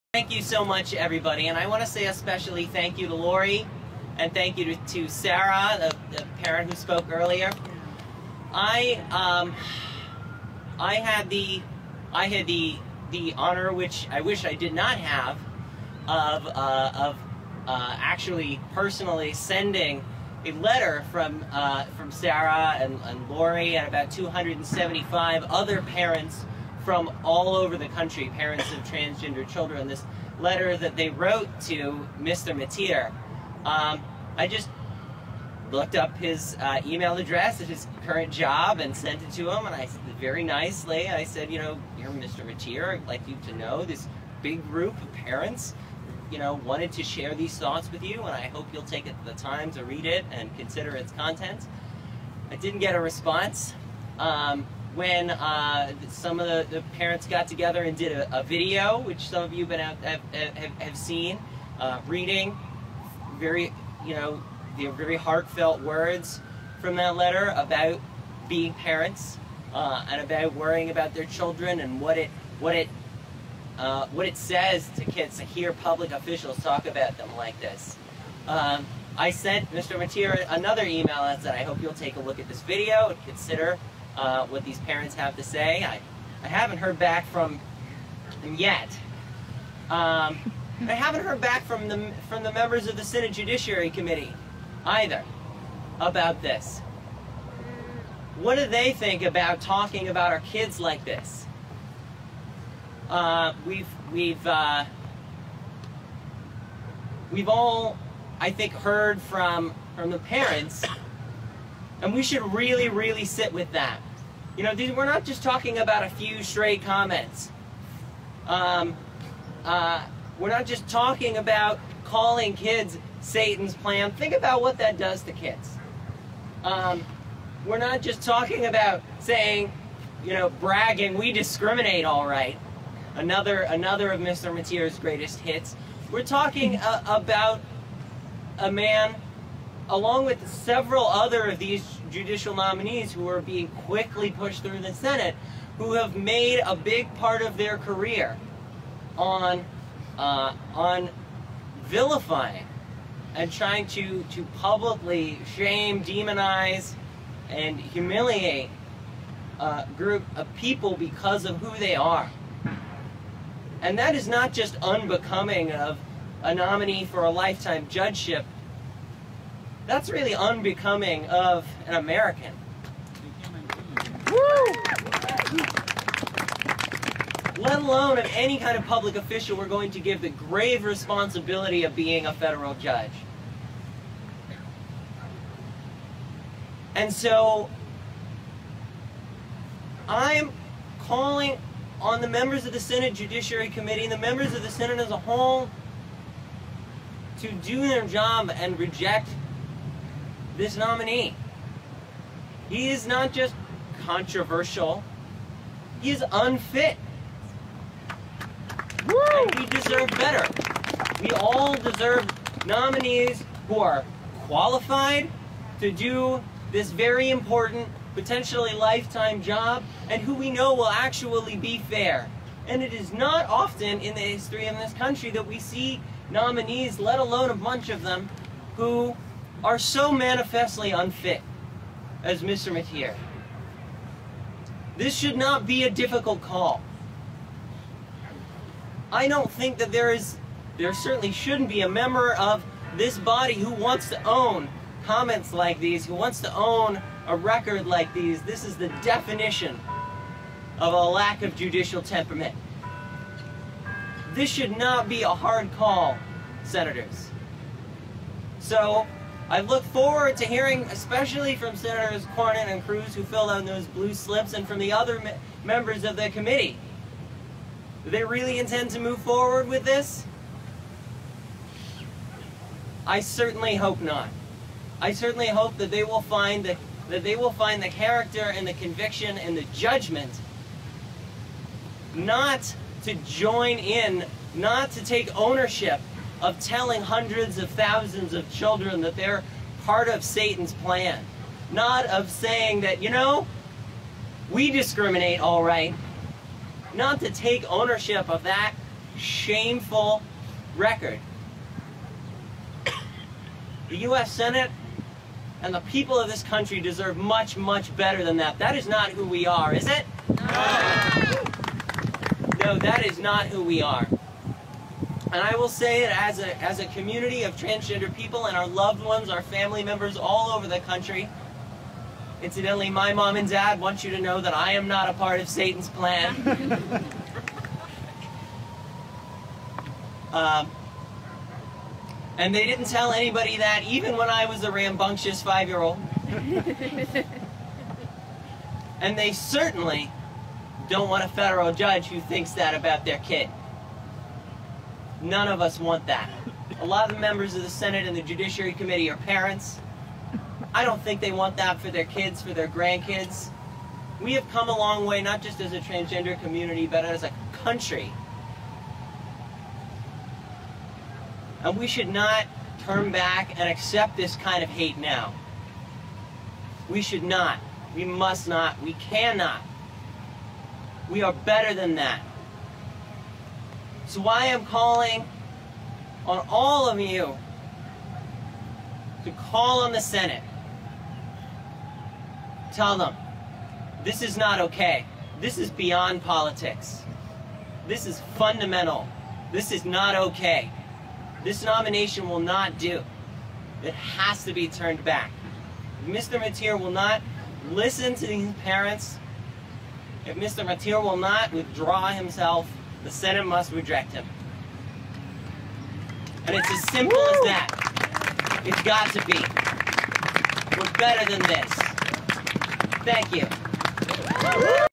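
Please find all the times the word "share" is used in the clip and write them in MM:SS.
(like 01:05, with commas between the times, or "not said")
00:47.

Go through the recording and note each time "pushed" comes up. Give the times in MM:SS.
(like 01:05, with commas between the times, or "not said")
02:24.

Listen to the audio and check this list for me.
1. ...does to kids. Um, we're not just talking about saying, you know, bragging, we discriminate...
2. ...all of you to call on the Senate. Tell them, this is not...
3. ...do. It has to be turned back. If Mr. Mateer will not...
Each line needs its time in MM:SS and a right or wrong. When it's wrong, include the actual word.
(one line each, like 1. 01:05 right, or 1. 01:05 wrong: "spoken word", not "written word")
1. 02:04 right
2. 06:16 right
3. 06:32 right.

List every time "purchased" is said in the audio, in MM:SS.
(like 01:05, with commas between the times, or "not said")
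not said.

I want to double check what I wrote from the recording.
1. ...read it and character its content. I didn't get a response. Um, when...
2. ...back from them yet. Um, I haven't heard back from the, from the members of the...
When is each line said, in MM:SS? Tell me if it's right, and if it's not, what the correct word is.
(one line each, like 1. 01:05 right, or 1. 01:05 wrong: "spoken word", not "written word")
1. 00:49 wrong: "consider", not "character"
2. 01:26 right.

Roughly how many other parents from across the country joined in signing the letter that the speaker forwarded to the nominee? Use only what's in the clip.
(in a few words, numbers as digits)
275.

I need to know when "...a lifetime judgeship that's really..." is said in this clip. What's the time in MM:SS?
02:47.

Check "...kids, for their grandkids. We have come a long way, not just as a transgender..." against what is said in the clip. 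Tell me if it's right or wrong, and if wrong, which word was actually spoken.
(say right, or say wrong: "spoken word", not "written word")
right.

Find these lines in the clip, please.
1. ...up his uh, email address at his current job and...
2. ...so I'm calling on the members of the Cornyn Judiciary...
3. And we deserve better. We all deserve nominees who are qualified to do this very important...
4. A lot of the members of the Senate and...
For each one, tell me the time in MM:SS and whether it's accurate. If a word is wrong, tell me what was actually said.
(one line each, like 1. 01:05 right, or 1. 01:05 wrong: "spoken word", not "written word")
1. 00:35 right
2. 03:07 wrong: "Senate", not "Cornyn"
3. 03:29 right
4. 05:46 right.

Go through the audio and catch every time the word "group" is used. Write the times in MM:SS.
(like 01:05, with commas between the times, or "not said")
00:44, 02:39.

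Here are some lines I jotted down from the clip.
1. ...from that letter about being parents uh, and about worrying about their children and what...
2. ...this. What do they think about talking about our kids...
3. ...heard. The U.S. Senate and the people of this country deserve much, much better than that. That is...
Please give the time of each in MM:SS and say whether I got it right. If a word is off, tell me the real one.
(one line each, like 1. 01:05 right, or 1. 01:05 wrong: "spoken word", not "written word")
1. 01:06 right
2. 01:36 right
3. 05:00 wrong: "record", not "heard".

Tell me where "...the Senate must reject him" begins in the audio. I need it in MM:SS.
06:43.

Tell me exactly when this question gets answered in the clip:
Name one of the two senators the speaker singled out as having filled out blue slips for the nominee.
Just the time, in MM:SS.
04:22.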